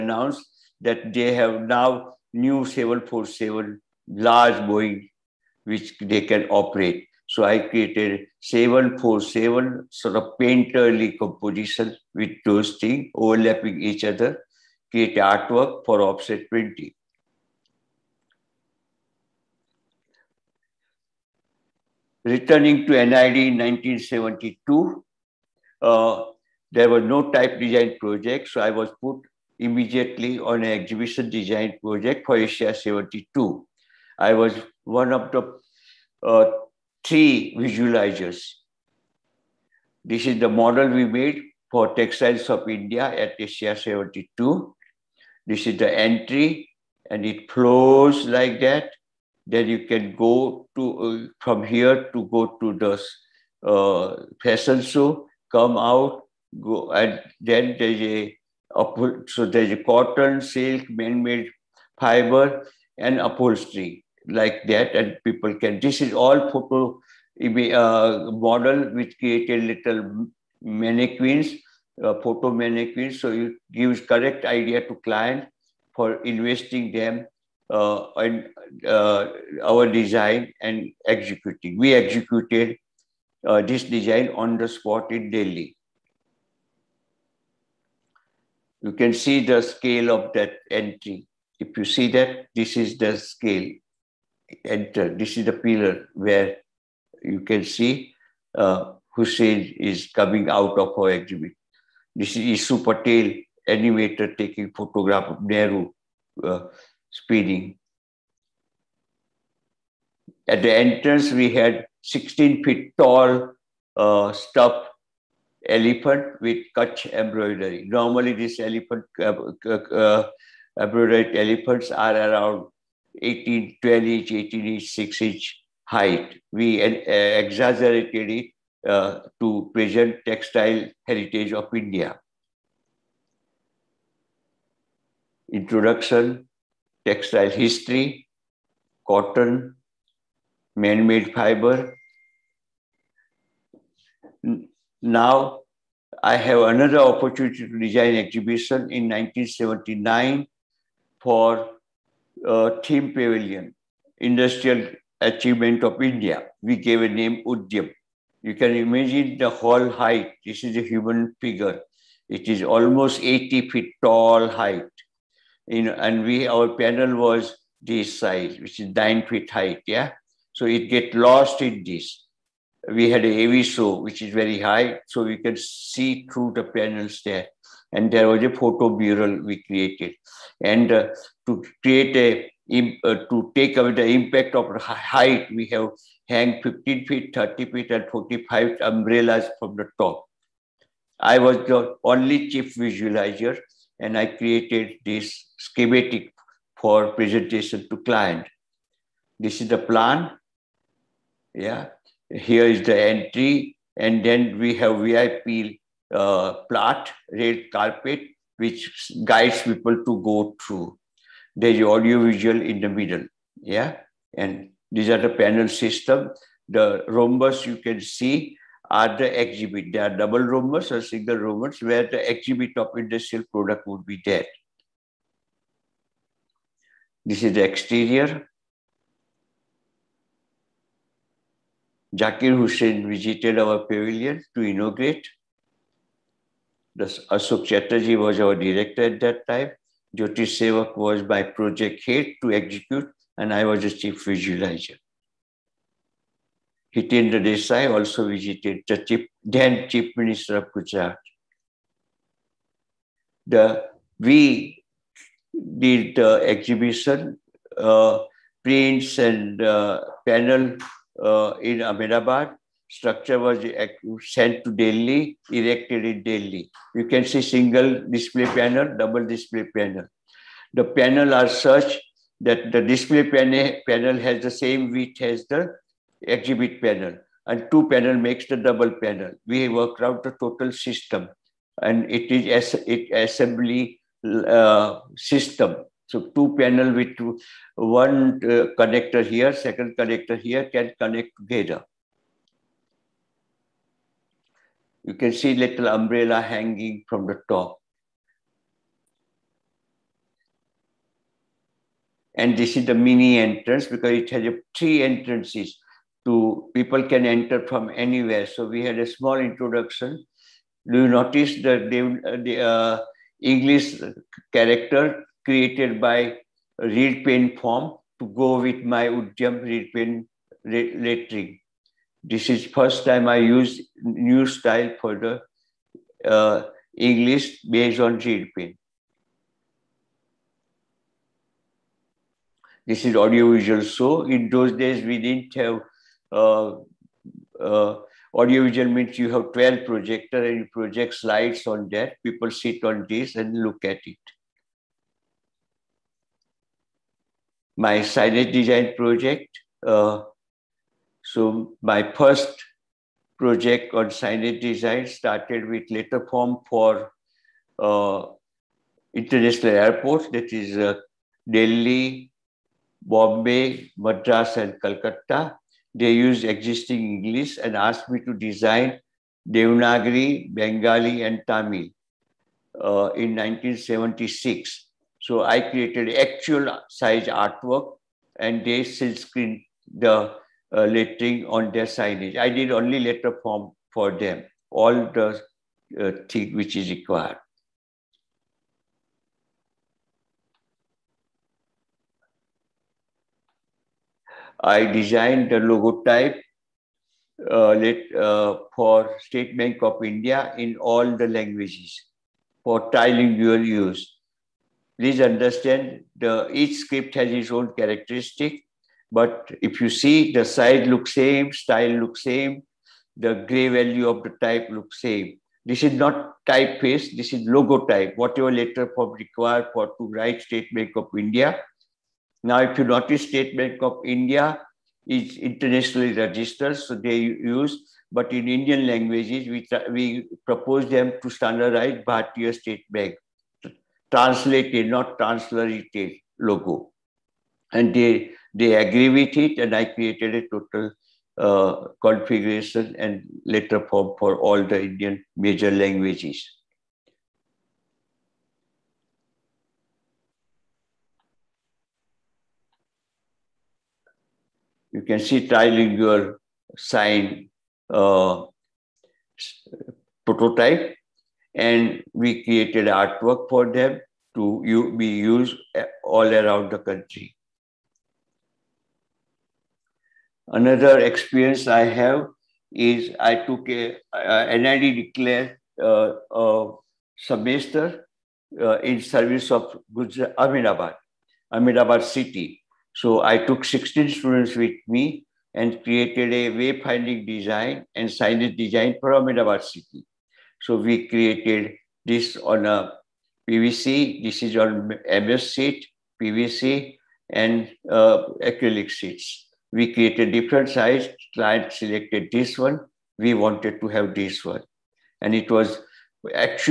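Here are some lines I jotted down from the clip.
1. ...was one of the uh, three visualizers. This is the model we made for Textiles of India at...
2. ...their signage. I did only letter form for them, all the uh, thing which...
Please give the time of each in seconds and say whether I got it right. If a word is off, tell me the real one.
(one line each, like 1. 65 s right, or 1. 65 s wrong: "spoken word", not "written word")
1. 34 s right
2. 381 s right.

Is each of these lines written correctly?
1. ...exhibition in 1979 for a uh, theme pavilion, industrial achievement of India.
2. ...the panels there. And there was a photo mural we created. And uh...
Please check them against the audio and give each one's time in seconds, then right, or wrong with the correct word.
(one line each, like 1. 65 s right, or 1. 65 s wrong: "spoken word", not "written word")
1. 148 s right
2. 176 s right.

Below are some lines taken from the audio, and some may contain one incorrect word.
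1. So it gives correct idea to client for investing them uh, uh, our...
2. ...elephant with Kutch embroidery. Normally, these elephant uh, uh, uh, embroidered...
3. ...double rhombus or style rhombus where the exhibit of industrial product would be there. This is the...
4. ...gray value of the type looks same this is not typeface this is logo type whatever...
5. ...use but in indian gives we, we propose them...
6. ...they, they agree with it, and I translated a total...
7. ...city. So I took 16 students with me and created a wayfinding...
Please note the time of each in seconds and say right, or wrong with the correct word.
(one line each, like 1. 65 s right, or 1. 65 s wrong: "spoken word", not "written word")
1. 73 s right
2. 115 s right
3. 220 s wrong: "single", not "style"
4. 413 s right
5. 427 s wrong: "languages", not "gives"
6. 437 s wrong: "created", not "translated"
7. 482 s right.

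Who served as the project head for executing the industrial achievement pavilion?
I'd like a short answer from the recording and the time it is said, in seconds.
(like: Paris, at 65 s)
Jyoti Sevak, at 240 s.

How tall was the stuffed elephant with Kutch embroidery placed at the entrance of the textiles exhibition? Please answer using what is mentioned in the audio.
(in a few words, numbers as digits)
16 feet.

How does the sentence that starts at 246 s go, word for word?
Hitendra Desai also visited the chief, then Chief Minister of Gujarat.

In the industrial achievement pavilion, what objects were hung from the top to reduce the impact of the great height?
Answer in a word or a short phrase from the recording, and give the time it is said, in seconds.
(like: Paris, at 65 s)
Umbrellas, at 188 s.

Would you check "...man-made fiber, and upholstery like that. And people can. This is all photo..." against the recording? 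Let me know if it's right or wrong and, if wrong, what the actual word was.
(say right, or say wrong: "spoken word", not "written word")
right.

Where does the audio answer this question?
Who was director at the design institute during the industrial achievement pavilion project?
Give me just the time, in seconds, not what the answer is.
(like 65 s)
237 s.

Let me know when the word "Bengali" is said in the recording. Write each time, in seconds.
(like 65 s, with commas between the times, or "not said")
370 s.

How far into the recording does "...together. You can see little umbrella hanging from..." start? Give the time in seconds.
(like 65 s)
291 s.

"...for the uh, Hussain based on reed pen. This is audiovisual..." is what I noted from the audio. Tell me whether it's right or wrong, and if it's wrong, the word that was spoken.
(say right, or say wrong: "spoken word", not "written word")
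wrong: "English", not "Hussain".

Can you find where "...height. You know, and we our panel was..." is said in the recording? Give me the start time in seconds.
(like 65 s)
164 s.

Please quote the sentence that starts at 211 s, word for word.
There's audio visual in the middle, yeah?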